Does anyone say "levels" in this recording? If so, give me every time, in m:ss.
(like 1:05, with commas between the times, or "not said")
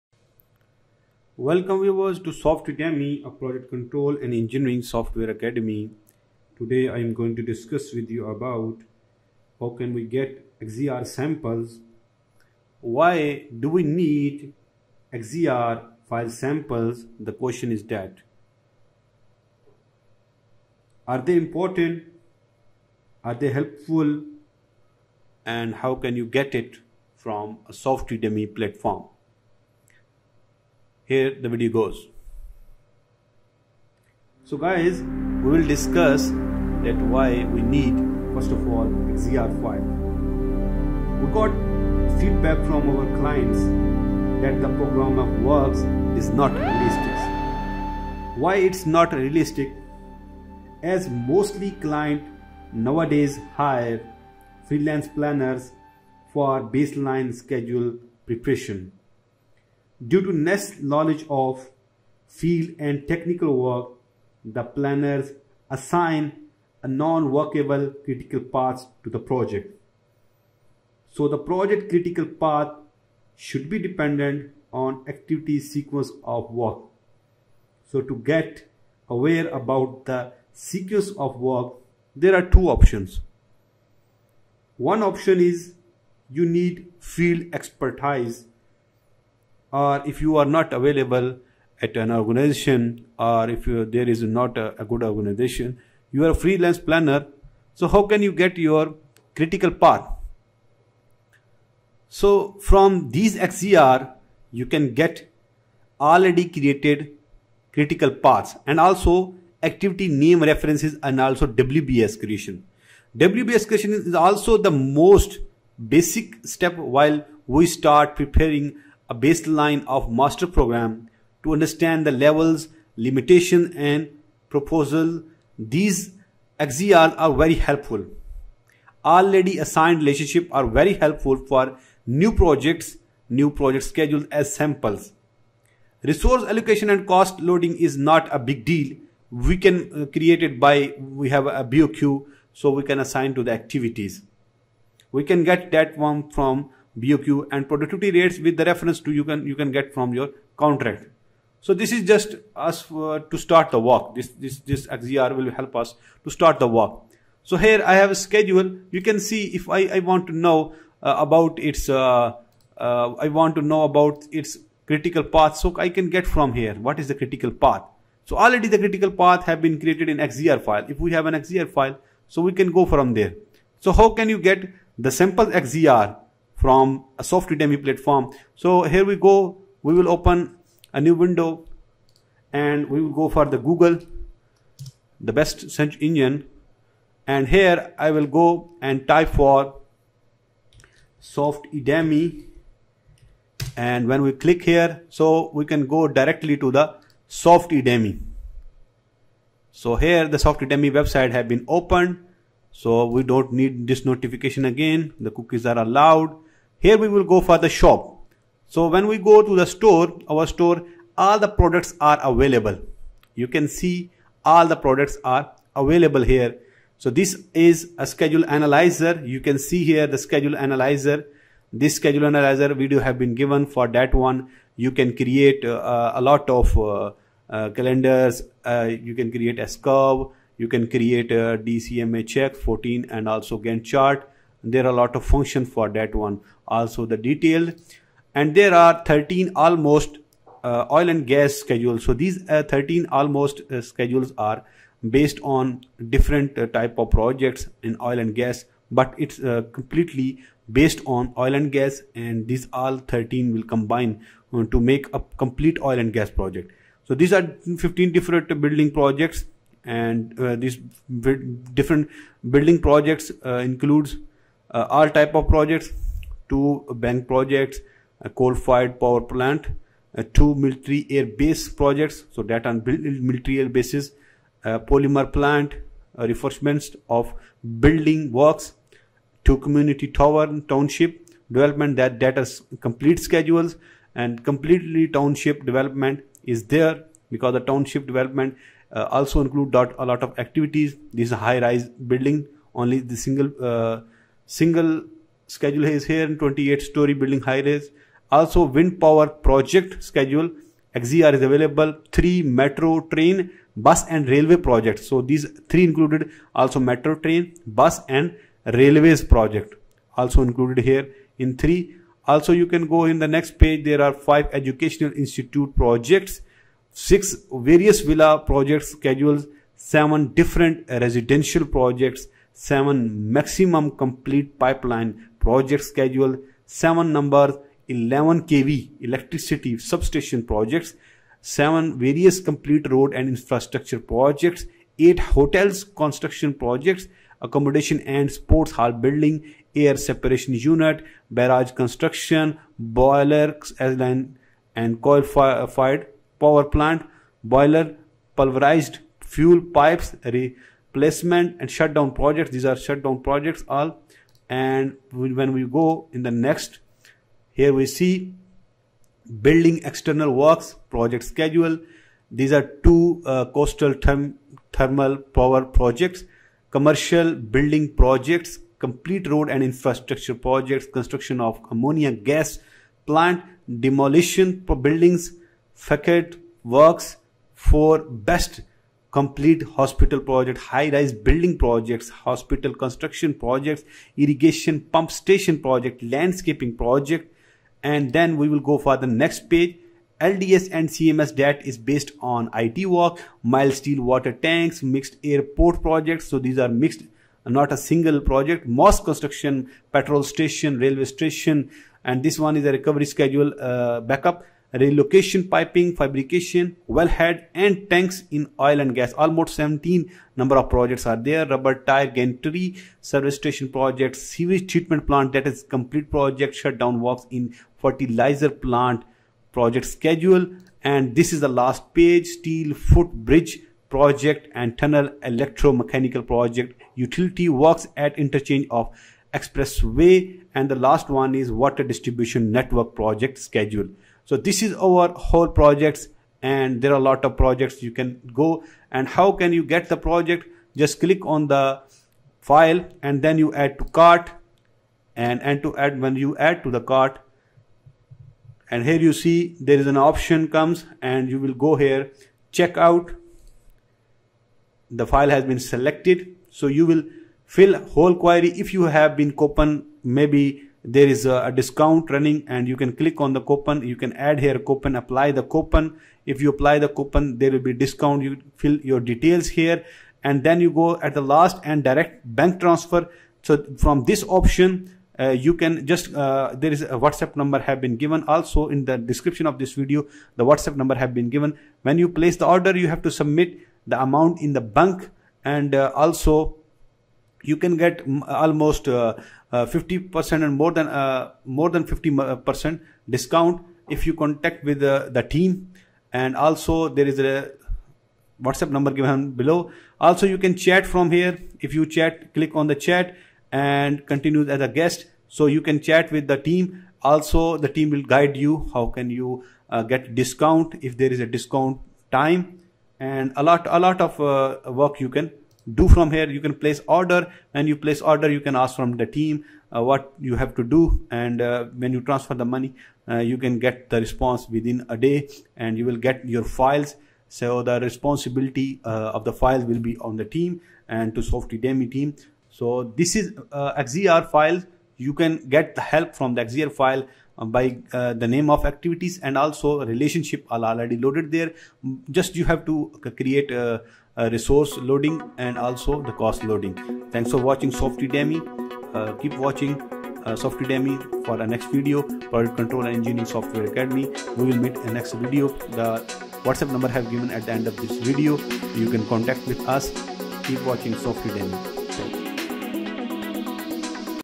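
2:02.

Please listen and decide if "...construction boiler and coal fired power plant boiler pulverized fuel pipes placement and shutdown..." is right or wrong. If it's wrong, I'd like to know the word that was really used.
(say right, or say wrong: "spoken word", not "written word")
right.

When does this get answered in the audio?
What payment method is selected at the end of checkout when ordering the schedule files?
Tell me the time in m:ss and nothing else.
7:51.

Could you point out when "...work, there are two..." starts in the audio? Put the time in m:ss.
1:21.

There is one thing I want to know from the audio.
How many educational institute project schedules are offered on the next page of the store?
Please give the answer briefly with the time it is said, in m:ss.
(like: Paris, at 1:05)
5, at 5:14.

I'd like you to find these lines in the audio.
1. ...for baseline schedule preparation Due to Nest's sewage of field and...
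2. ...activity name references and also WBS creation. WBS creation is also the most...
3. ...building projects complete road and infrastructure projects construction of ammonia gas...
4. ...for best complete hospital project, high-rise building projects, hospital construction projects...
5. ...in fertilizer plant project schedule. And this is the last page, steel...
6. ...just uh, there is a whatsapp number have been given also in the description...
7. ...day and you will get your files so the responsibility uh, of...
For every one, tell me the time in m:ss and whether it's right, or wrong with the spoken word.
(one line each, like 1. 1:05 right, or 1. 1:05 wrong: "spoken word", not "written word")
1. 0:56 wrong: "knowledge", not "sewage"
2. 1:49 right
3. 6:07 right
4. 6:17 right
5. 6:57 right
6. 7:55 right
7. 8:44 right.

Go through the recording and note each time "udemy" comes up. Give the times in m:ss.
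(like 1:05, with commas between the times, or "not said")
3:11.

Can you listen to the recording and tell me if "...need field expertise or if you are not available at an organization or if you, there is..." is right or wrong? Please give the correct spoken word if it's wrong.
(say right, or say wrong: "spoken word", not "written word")
right.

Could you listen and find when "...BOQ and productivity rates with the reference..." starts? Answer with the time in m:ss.
2:26.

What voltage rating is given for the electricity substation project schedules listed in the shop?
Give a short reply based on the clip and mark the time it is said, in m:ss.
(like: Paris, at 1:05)
11 kV, at 5:27.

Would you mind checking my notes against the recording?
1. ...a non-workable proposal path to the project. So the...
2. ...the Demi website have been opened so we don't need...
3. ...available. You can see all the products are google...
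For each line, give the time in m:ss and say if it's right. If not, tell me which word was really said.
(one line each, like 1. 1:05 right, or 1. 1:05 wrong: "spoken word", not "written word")
1. 1:06 wrong: "critical", not "proposal"
2. 3:20 wrong: "SoftEdemy", not "Demi"
3. 3:32 wrong: "available", not "google".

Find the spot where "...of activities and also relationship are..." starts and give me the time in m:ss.
8:58.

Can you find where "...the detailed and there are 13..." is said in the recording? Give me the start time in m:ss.
3:57.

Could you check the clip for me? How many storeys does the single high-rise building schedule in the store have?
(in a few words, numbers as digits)
28.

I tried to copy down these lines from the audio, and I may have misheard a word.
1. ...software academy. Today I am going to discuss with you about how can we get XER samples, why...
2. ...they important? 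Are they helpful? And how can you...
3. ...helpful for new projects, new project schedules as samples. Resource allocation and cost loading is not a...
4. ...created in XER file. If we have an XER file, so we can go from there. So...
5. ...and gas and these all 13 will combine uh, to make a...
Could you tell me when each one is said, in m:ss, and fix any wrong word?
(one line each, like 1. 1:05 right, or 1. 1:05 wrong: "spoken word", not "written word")
1. 0:04 right
2. 0:21 right
3. 2:10 right
4. 2:49 right
5. 4:11 right.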